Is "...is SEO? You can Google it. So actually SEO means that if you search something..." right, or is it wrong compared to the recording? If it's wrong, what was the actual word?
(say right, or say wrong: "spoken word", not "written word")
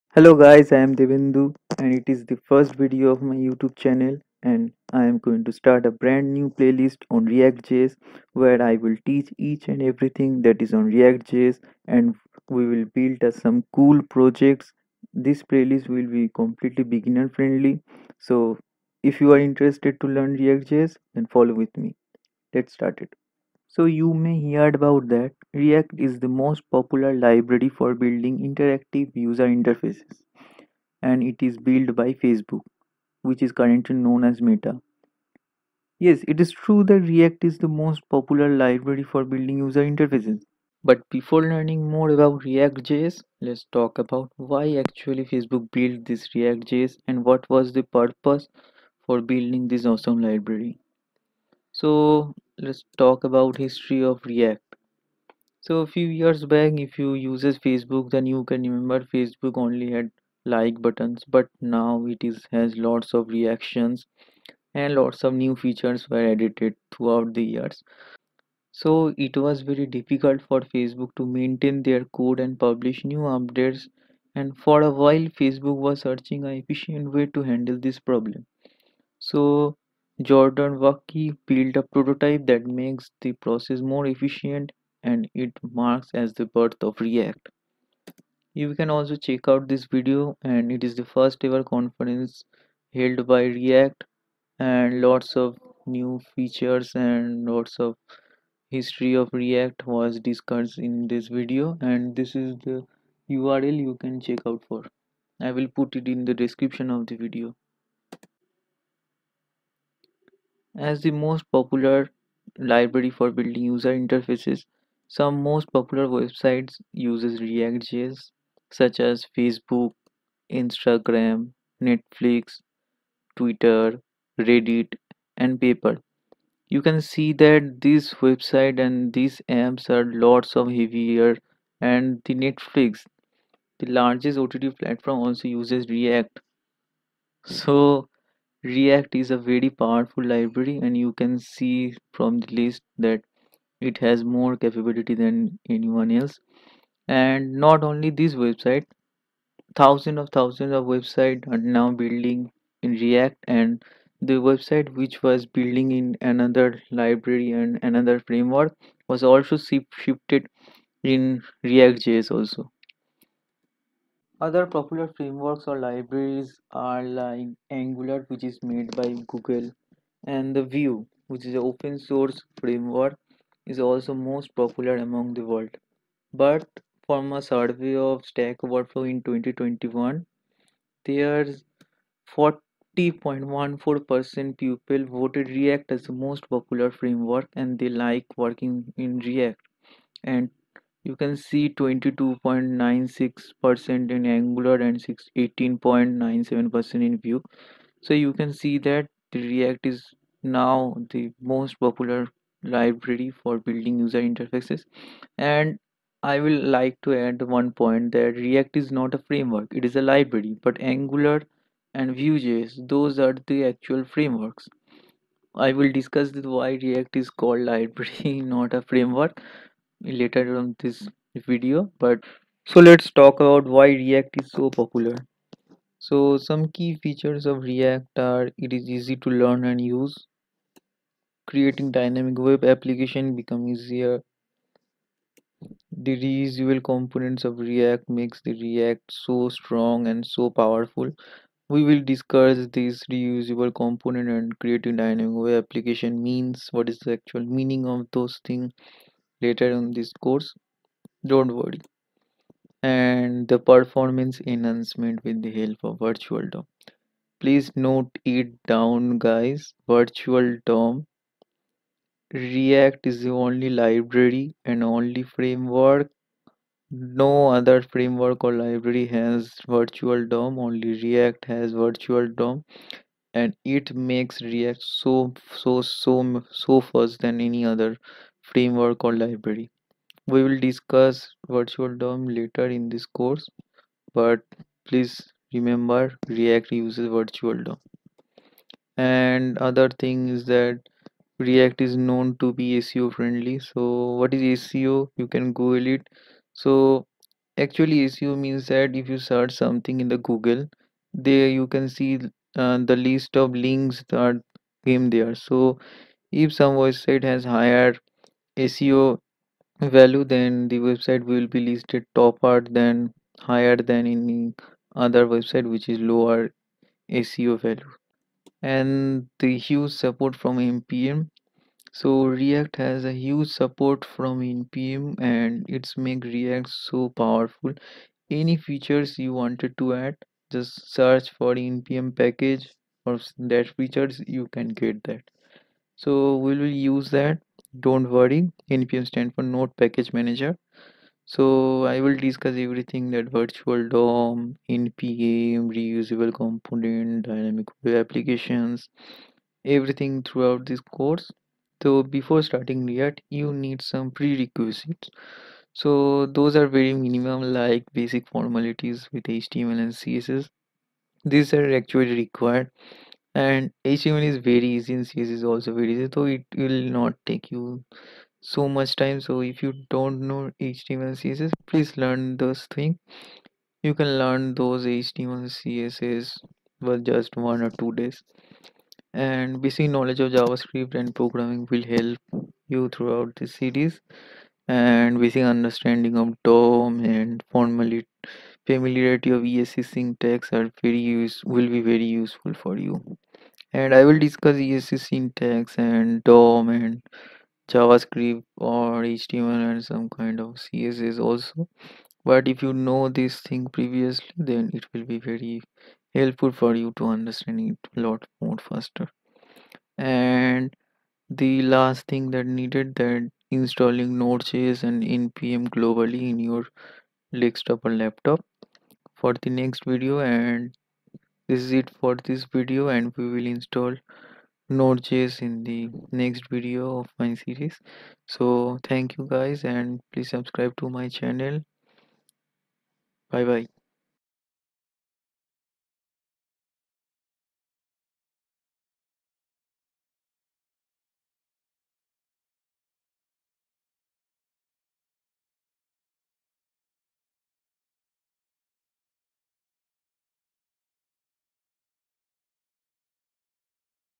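right.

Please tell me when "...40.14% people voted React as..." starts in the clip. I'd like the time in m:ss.
3:02.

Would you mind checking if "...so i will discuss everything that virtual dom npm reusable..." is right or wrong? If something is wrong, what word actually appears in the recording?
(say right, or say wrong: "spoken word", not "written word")
right.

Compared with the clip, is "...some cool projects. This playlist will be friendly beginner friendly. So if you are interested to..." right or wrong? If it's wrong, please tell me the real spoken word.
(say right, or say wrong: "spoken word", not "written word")
wrong: "completely", not "friendly".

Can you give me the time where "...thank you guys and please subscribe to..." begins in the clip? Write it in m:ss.
7:08.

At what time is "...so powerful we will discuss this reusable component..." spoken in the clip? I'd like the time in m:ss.
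4:00.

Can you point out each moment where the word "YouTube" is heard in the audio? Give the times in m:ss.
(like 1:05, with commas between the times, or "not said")
0:03.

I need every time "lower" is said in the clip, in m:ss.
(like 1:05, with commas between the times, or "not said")
5:15.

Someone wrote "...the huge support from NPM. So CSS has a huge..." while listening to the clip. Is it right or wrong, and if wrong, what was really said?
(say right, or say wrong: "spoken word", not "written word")
wrong: "React", not "CSS".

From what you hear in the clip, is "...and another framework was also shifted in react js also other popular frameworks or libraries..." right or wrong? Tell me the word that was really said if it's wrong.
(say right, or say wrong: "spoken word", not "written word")
right.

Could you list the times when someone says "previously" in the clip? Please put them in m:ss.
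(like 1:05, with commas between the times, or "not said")
6:43.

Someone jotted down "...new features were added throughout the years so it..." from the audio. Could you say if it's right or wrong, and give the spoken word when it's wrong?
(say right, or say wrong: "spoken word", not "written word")
right.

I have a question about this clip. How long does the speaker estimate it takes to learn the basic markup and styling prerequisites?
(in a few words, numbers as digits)
one or two days.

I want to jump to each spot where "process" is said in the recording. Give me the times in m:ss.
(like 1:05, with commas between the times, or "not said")
1:23.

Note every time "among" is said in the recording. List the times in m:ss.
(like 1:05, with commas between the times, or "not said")
2:54.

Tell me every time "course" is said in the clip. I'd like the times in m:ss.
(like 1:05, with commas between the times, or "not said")
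4:10, 4:43, 5:50.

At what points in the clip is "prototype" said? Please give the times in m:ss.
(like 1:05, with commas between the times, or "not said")
1:21.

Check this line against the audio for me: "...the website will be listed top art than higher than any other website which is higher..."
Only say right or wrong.
wrong.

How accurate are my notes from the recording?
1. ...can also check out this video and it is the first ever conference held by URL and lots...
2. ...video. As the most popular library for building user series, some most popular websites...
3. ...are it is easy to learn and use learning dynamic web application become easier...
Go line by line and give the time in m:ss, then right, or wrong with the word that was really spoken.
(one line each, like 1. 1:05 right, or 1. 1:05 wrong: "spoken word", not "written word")
1. 1:28 wrong: "React", not "URL"
2. 1:47 wrong: "interfaces", not "series"
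3. 3:48 wrong: "creating", not "learning".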